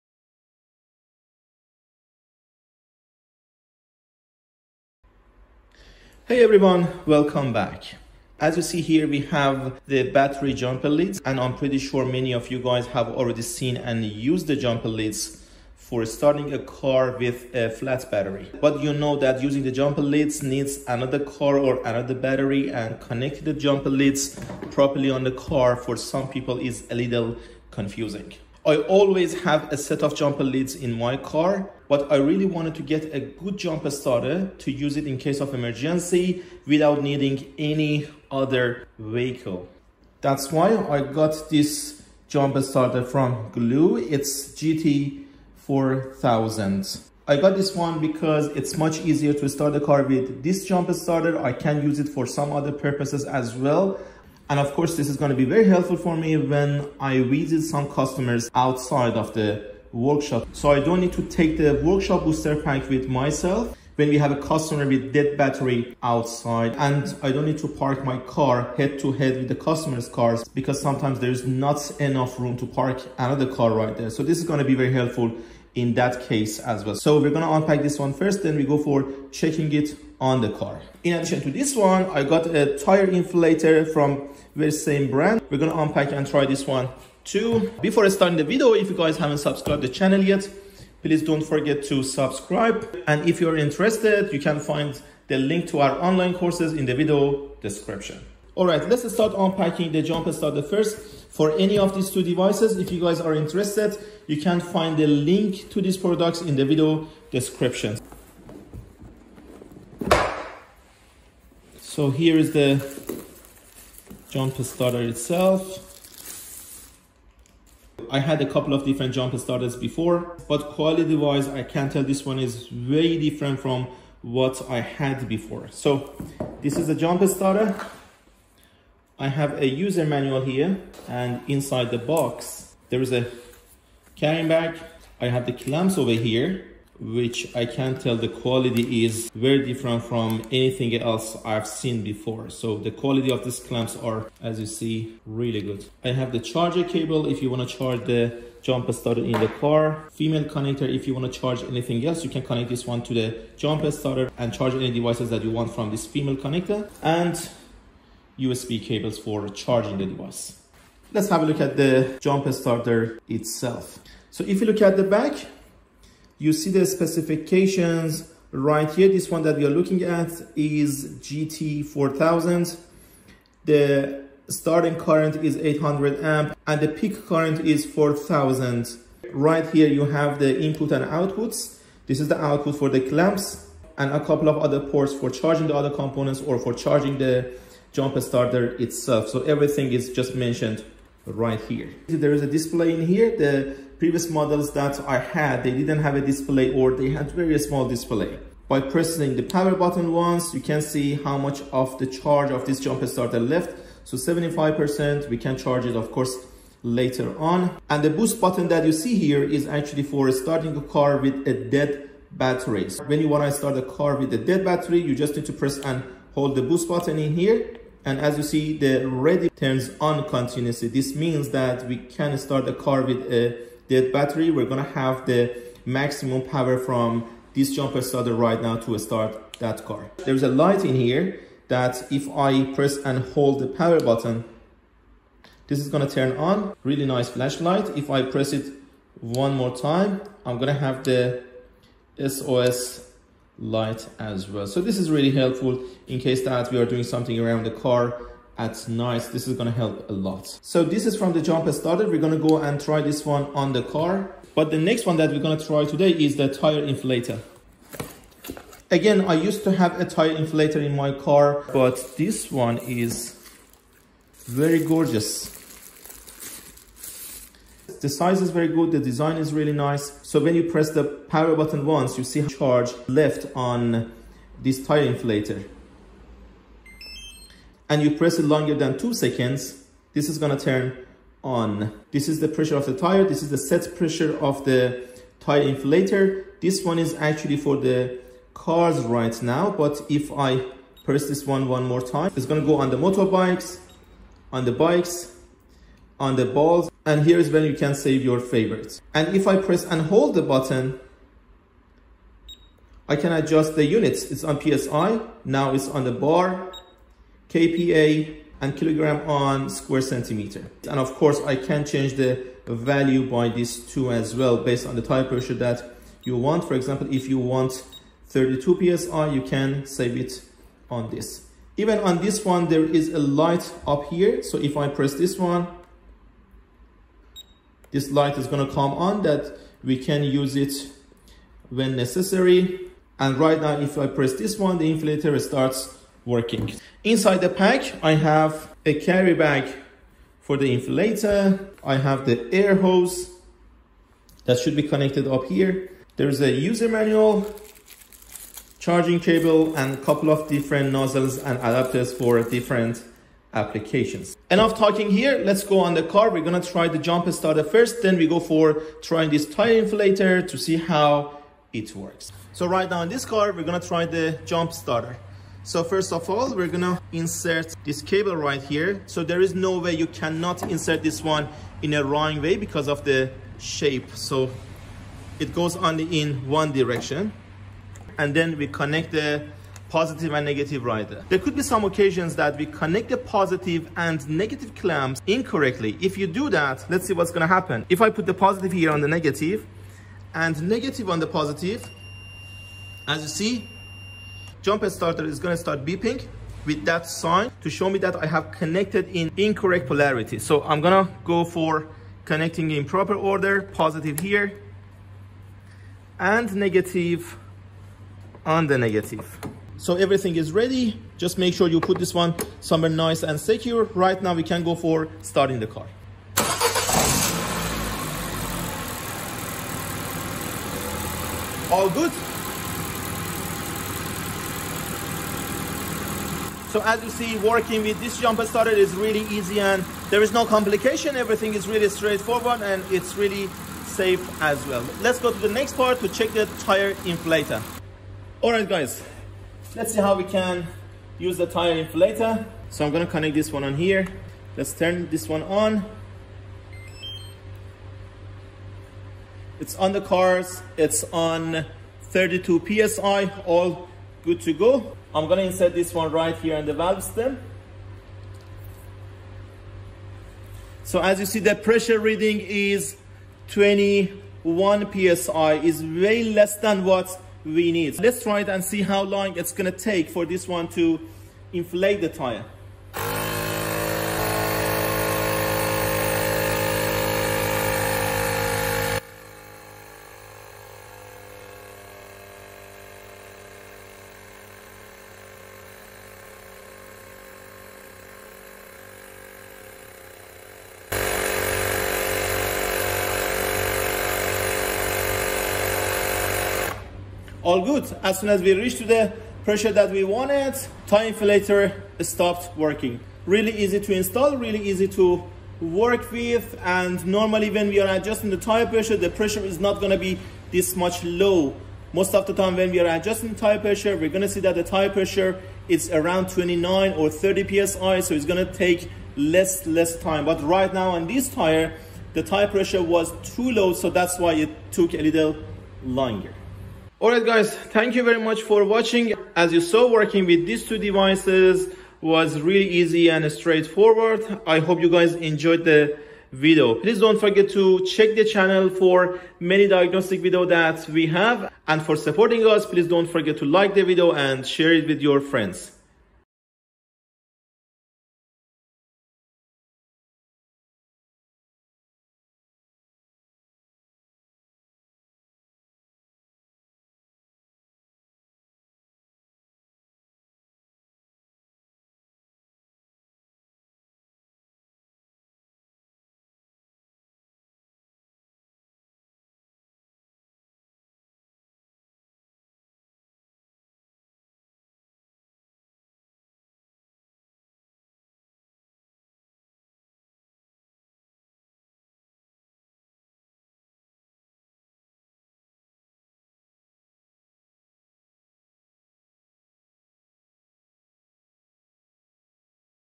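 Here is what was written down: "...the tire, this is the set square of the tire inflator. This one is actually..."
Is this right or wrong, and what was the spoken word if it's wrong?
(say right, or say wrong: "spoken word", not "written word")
wrong: "pressure", not "square".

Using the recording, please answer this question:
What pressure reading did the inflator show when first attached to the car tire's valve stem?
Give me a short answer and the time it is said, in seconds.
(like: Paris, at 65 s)
21 PSI, at 463 s.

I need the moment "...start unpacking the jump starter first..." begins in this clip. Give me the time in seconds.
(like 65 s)
99 s.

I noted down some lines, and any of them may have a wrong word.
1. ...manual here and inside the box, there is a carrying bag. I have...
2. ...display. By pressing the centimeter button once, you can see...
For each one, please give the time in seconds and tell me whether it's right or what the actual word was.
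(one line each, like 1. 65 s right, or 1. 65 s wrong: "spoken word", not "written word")
1. 130 s right
2. 197 s wrong: "power", not "centimeter".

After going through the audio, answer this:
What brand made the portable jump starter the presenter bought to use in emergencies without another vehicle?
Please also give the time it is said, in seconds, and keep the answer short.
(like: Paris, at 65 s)
GOOLOO, at 43 s.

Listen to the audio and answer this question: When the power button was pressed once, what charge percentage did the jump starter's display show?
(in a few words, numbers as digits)
75%.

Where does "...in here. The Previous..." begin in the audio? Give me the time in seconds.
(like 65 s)
192 s.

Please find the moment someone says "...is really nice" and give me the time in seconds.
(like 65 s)
269 s.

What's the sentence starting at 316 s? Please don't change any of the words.
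For example, if you want 32 PSI, you can save it on this.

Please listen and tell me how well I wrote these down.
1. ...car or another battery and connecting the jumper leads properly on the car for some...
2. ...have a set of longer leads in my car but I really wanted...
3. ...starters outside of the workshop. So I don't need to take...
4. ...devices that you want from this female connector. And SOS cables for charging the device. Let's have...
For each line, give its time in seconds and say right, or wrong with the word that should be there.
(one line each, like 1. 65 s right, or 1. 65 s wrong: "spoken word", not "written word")
1. 21 s right
2. 29 s wrong: "jumper", not "longer"
3. 57 s wrong: "customers", not "starters"
4. 154 s wrong: "USB", not "SOS".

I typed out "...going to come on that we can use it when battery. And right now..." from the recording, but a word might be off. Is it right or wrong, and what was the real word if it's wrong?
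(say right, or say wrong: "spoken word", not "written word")
wrong: "necessary", not "battery".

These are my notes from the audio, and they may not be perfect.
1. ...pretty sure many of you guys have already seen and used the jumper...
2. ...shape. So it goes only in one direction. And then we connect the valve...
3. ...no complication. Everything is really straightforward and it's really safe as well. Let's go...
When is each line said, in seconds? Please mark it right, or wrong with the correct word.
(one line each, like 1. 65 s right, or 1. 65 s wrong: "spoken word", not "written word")
1. 11 s right
2. 373 s wrong: "positive", not "valve"
3. 430 s right.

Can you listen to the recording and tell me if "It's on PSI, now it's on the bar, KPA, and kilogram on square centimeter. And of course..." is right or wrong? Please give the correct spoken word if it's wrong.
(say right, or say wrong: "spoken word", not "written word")
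right.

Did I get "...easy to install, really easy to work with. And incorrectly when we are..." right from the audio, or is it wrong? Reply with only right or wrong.
wrong.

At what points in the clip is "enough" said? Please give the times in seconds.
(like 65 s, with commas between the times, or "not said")
71 s, 354 s.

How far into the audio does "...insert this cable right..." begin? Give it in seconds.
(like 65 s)
367 s.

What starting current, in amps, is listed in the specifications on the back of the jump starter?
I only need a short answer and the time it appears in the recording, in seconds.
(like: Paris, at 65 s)
800, at 175 s.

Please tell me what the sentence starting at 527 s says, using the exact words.
Alright guys, thank you very much for watching.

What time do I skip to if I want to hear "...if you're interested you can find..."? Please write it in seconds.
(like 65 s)
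93 s.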